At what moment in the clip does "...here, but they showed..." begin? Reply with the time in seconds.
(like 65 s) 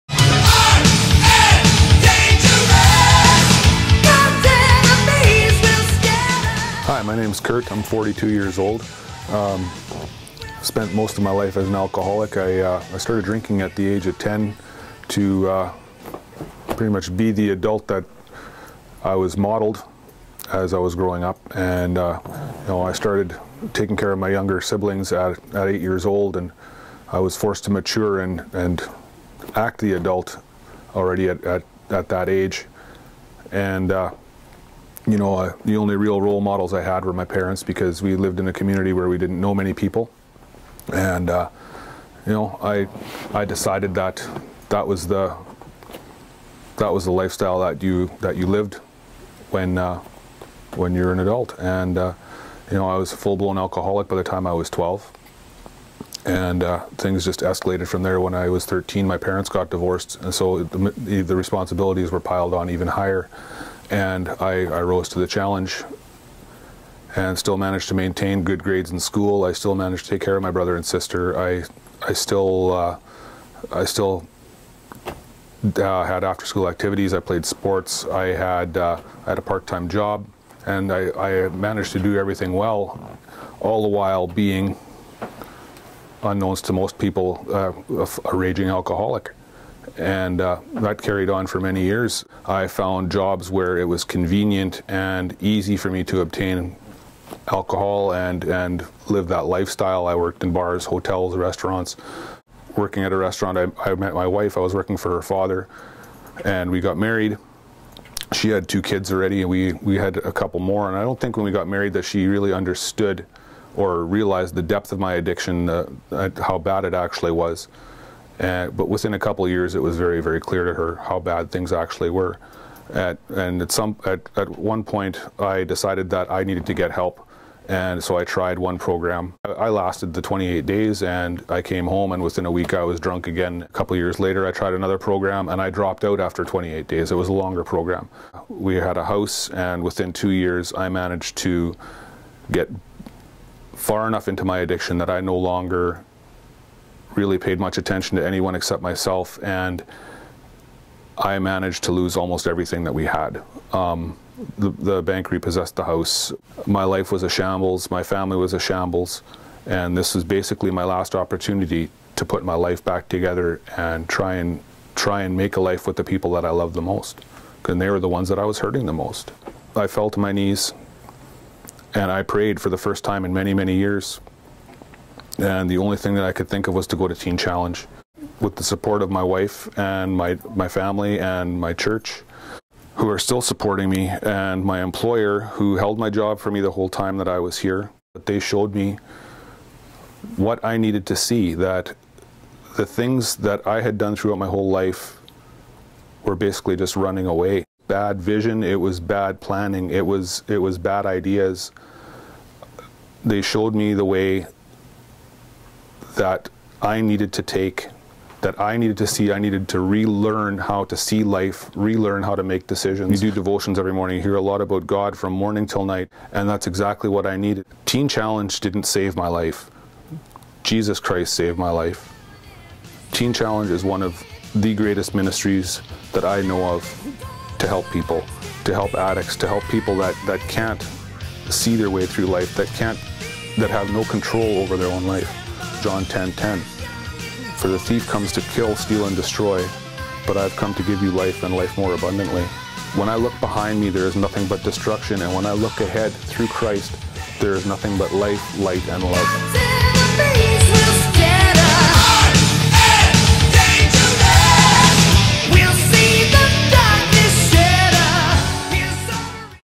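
187 s.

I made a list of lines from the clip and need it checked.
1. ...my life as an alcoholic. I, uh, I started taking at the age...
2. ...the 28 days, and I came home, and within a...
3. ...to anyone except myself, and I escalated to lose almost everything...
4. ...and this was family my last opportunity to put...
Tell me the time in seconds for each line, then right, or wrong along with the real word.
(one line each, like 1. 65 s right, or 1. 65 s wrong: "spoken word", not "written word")
1. 11 s wrong: "drinking", not "taking"
2. 130 s right
3. 148 s wrong: "managed", not "escalated"
4. 159 s wrong: "basically", not "family".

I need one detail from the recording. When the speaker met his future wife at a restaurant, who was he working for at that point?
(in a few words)
her father.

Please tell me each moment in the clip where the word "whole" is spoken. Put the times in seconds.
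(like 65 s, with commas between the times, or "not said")
186 s, 194 s.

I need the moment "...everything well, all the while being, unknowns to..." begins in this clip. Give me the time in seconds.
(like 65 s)
82 s.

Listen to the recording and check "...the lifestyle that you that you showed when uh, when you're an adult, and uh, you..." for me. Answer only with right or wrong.
wrong.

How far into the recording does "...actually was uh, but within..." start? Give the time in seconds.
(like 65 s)
116 s.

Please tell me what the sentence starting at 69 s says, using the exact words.
I still managed to take care of my brother and sister.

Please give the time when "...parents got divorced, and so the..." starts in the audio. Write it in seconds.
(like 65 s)
59 s.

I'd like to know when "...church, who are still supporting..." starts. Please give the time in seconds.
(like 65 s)
181 s.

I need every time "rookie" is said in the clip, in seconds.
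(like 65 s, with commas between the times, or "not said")
not said.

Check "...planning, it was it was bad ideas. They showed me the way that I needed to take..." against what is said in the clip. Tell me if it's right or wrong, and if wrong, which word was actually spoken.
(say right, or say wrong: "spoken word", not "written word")
right.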